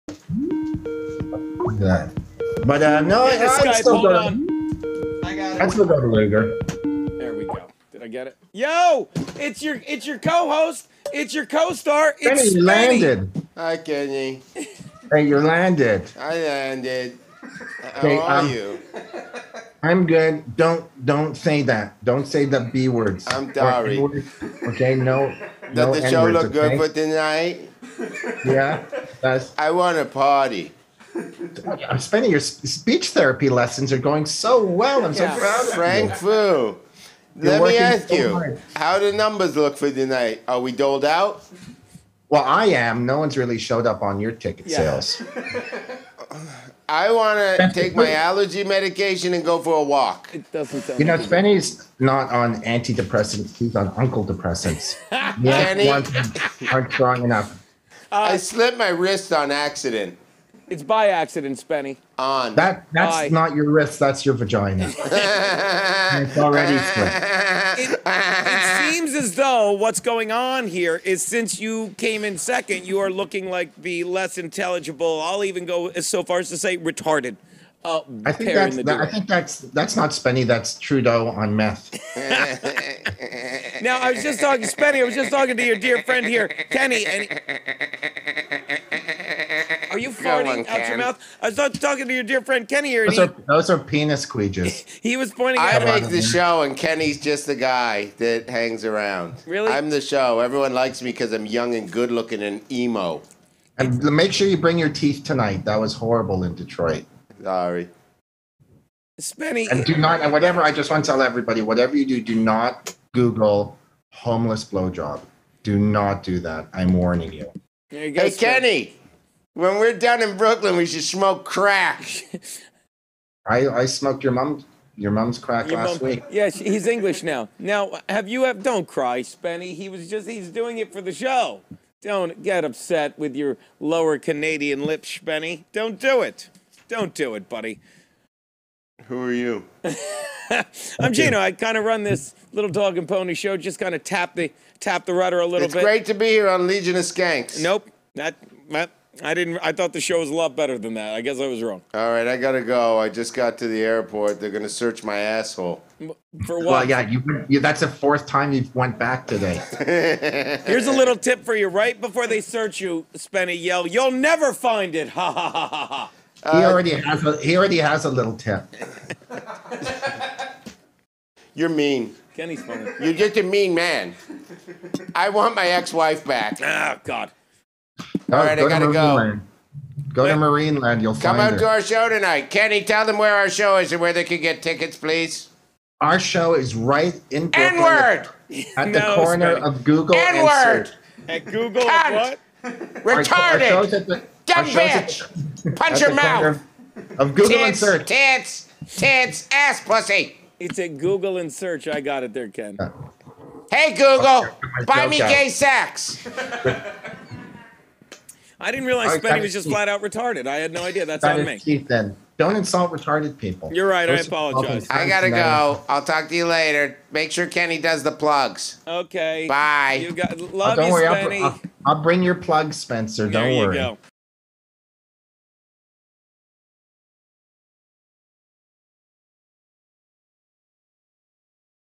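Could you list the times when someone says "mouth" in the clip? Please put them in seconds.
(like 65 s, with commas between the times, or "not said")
90 s, 196 s.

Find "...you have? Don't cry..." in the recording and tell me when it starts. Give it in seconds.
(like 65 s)
128 s.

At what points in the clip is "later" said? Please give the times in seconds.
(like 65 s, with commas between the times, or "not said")
216 s.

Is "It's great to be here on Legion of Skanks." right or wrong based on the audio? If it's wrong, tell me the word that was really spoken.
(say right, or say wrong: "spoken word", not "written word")
right.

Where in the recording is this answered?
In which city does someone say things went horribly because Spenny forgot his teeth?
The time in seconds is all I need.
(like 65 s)
106 s.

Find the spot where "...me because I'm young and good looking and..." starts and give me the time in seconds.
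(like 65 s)
101 s.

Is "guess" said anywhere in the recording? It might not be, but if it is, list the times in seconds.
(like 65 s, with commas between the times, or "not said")
151 s.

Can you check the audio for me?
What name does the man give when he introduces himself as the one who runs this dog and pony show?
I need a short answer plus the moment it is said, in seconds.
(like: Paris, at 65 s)
Geno, at 141 s.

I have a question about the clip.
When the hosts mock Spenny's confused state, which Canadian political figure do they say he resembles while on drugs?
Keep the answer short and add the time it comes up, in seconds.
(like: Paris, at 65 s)
Trudeau, at 80 s.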